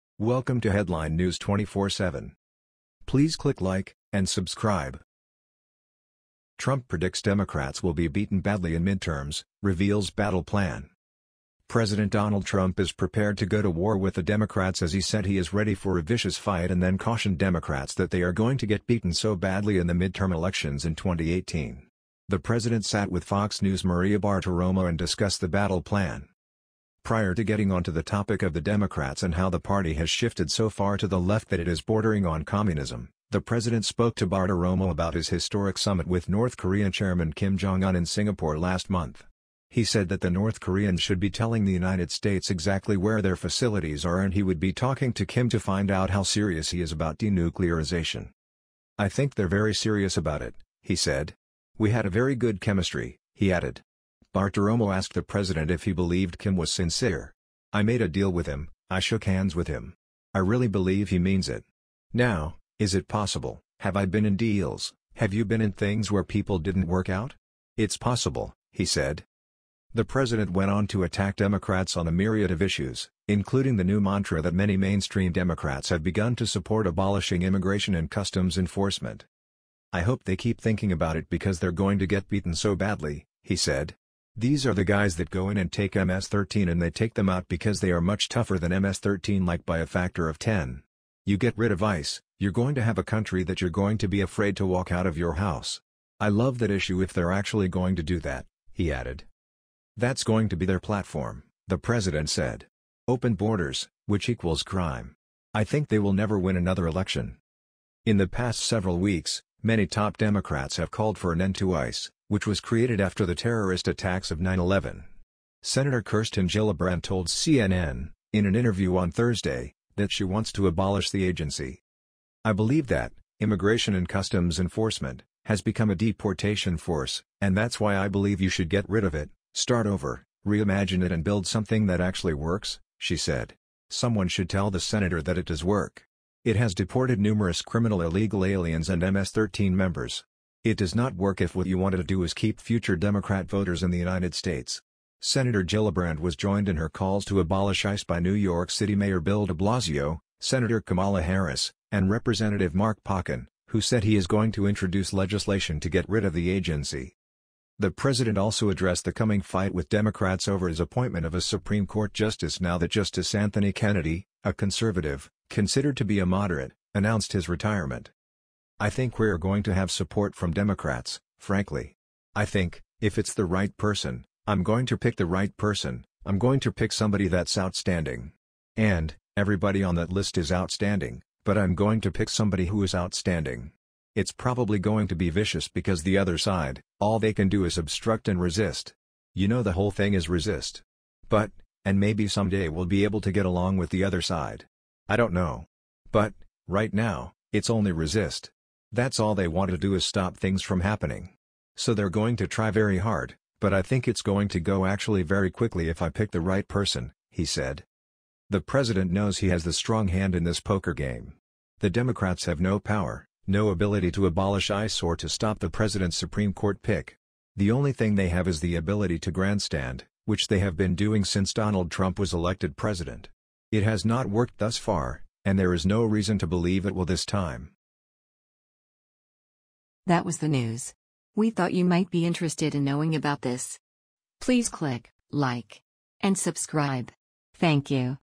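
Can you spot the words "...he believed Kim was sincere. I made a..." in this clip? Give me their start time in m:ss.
0:55.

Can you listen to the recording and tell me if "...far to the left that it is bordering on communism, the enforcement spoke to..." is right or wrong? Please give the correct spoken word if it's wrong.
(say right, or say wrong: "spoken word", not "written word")
wrong: "president", not "enforcement".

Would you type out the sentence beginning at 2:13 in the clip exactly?
Someone should tell the senator that it does work.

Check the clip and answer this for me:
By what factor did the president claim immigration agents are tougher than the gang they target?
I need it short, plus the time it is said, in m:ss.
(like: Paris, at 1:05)
10, at 1:29.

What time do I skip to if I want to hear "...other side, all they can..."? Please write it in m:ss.
3:06.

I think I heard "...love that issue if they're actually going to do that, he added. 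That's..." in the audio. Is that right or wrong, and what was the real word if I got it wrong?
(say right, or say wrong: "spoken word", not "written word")
right.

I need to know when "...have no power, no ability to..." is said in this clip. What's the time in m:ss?
3:32.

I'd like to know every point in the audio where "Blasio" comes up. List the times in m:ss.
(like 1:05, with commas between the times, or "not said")
2:29.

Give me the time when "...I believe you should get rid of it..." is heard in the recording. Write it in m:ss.
2:07.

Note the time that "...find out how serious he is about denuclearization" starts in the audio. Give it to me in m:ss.
0:45.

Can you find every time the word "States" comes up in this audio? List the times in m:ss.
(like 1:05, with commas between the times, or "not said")
0:42, 2:24.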